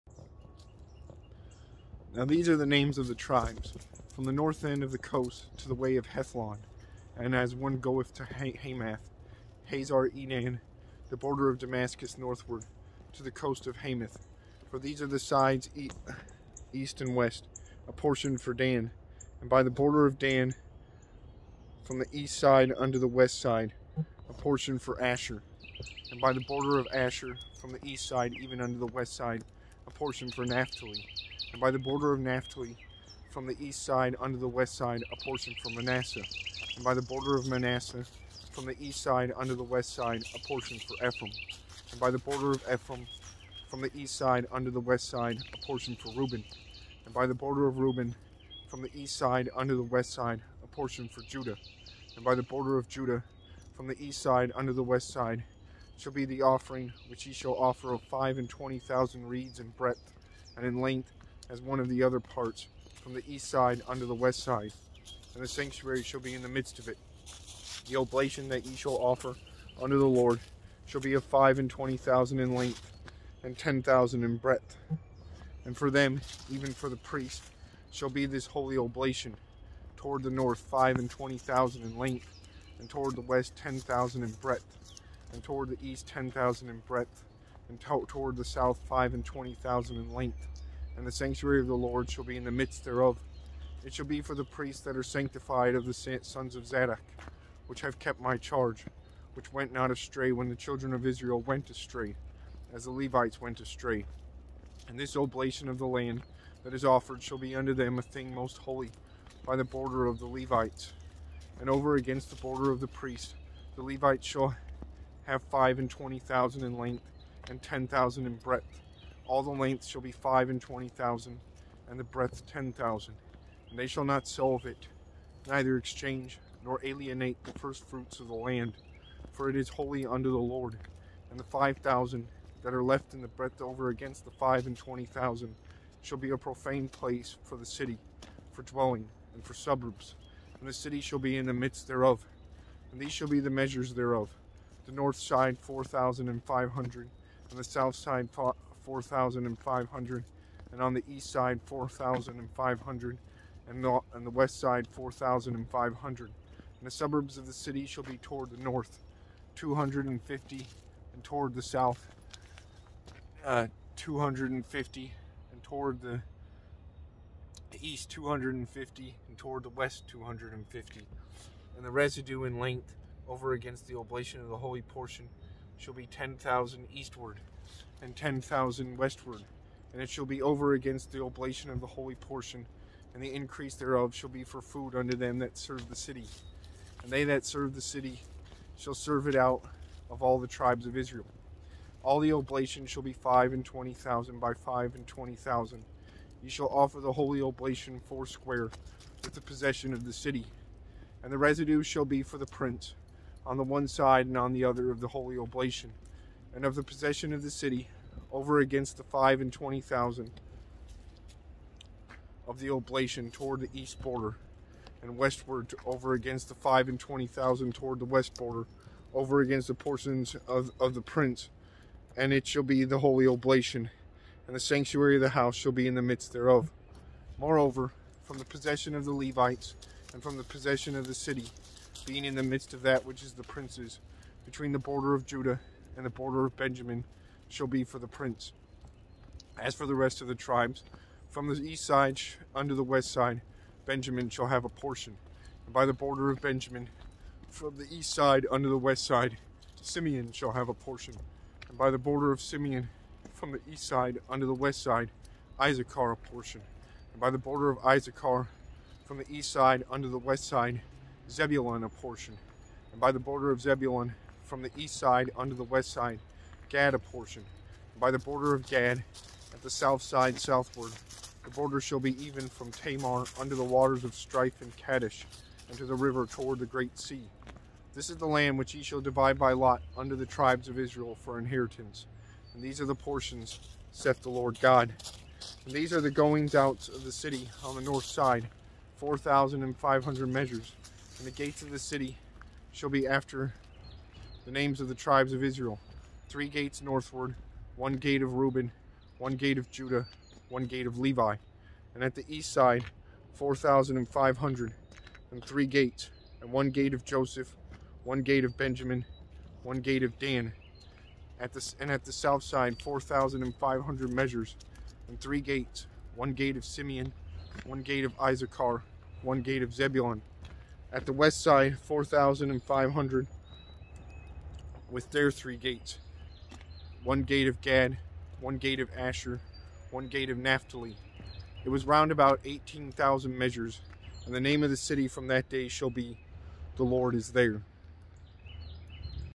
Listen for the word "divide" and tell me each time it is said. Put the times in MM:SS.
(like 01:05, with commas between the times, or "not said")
04:39.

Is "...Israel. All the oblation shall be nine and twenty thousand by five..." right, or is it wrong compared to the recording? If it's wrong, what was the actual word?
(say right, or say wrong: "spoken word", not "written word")
wrong: "five", not "nine".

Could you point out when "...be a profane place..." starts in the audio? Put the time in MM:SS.
02:16.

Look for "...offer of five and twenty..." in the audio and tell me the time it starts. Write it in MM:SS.
00:57.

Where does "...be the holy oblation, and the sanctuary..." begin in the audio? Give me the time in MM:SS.
03:42.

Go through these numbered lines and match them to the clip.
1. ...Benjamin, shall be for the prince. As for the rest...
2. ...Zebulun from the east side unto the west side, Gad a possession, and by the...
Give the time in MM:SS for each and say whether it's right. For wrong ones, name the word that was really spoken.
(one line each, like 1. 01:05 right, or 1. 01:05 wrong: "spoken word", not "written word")
1. 03:56 right
2. 04:23 wrong: "portion", not "possession".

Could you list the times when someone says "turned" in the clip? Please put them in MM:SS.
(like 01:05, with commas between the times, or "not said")
not said.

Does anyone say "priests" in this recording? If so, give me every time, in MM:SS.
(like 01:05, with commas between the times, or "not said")
01:16, 01:34, 01:52.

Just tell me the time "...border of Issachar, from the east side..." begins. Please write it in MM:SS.
04:17.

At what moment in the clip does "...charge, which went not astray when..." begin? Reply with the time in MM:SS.
01:38.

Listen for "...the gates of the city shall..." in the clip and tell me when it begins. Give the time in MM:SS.
04:51.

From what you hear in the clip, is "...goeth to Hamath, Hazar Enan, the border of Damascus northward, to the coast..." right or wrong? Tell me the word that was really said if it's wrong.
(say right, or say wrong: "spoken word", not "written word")
right.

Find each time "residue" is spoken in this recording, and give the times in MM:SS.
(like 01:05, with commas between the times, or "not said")
02:51, 03:21.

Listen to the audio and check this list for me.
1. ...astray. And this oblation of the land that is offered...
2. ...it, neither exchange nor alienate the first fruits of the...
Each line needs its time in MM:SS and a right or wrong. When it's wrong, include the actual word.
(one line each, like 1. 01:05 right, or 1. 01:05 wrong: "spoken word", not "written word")
1. 01:43 right
2. 02:04 right.